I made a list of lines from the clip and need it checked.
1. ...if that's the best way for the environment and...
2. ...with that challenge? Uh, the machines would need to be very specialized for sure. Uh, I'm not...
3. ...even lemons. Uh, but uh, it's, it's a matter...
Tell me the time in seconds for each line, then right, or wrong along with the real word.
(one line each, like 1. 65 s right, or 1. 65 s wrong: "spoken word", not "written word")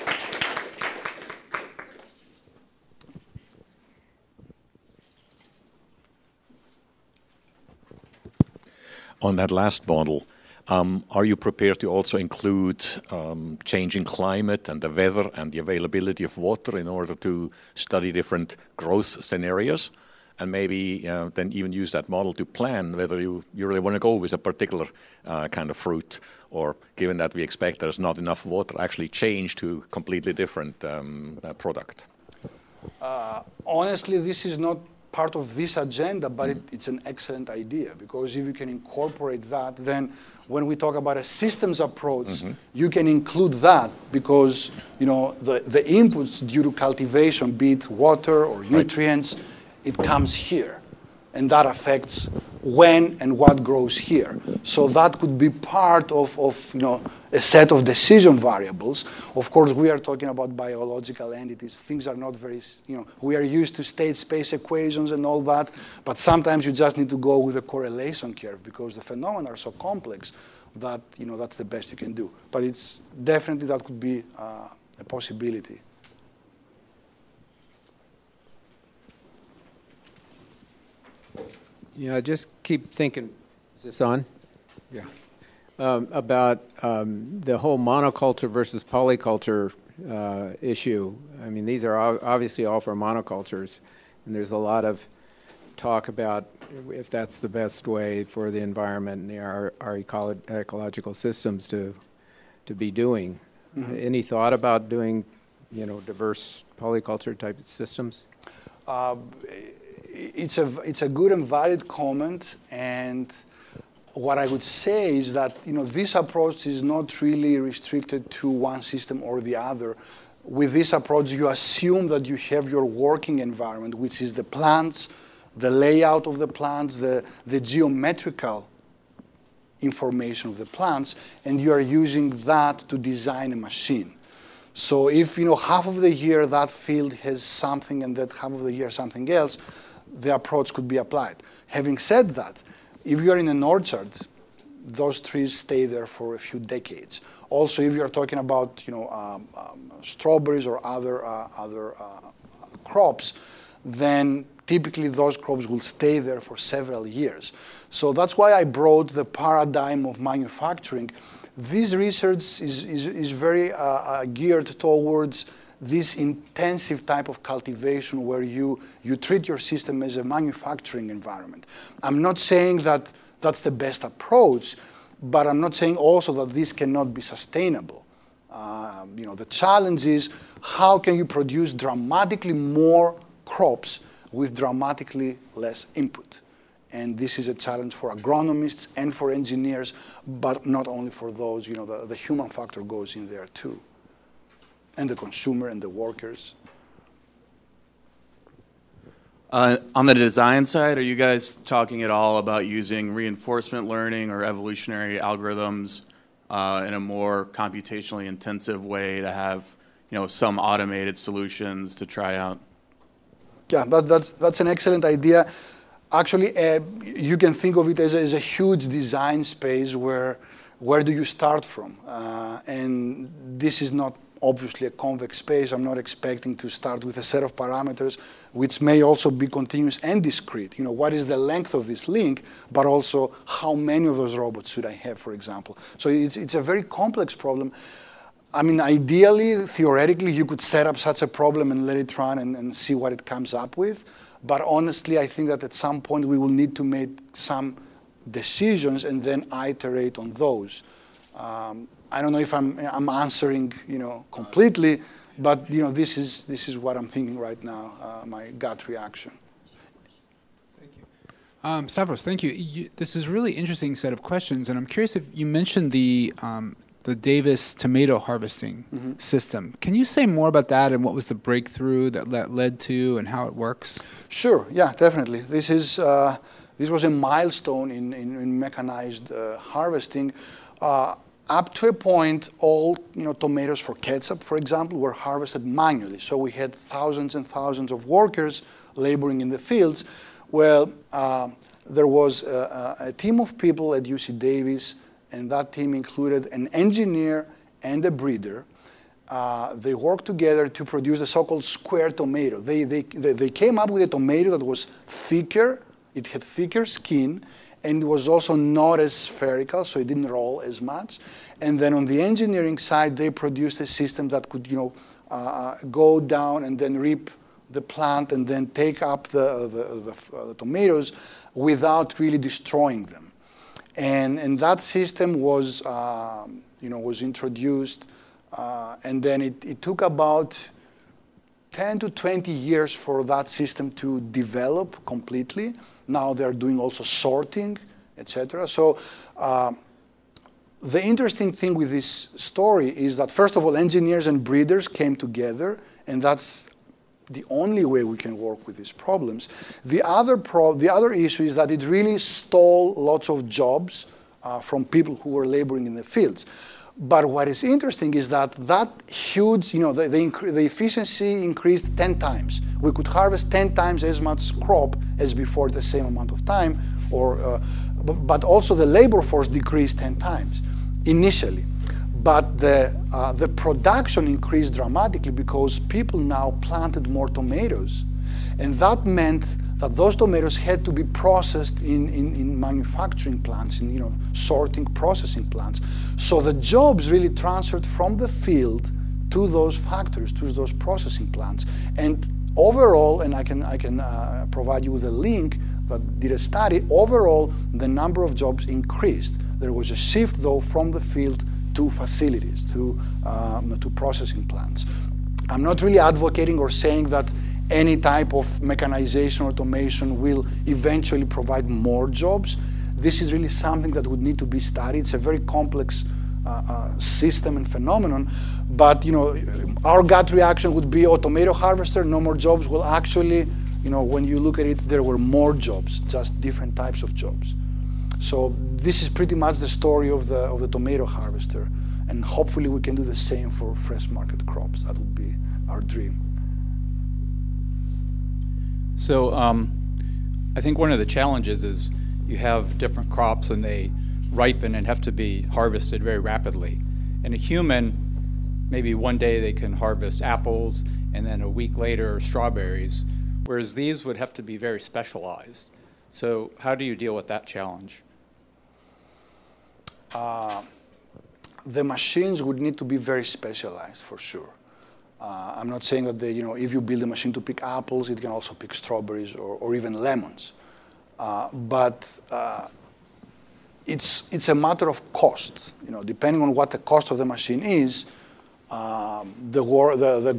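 1. 96 s right
2. 457 s right
3. 469 s right.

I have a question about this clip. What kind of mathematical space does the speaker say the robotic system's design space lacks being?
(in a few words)
convex.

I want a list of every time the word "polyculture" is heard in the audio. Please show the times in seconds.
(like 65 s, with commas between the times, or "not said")
88 s, 106 s.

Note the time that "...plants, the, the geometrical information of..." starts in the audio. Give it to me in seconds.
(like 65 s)
126 s.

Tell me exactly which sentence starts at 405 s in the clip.
I'm not really advocating or saying that any type of mechanization, or automation will eventually provide more jobs.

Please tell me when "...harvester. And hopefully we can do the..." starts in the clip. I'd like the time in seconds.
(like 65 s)
431 s.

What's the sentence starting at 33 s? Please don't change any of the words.
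Uh, honestly, this is not part of this agenda, but it, mm.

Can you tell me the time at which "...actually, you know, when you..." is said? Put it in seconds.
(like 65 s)
422 s.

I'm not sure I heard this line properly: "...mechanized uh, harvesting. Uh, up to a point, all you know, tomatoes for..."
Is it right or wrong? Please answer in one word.
right.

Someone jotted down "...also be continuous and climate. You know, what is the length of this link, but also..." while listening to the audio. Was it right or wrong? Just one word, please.
wrong.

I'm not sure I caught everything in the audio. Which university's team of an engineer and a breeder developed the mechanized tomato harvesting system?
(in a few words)
UC Davis.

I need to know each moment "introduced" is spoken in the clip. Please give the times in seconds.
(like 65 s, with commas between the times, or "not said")
327 s.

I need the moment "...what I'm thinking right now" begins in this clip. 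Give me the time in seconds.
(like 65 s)
256 s.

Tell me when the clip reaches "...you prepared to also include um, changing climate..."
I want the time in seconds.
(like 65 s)
11 s.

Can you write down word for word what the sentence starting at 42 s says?
you can include that because you know the, the inputs due to cultivation, be it water or nutrients, right.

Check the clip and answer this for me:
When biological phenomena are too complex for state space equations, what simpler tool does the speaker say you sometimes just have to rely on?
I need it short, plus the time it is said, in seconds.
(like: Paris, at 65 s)
correlation curve, at 67 s.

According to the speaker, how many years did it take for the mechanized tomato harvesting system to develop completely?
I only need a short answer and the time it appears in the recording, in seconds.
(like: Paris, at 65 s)
10 to 20 years, at 331 s.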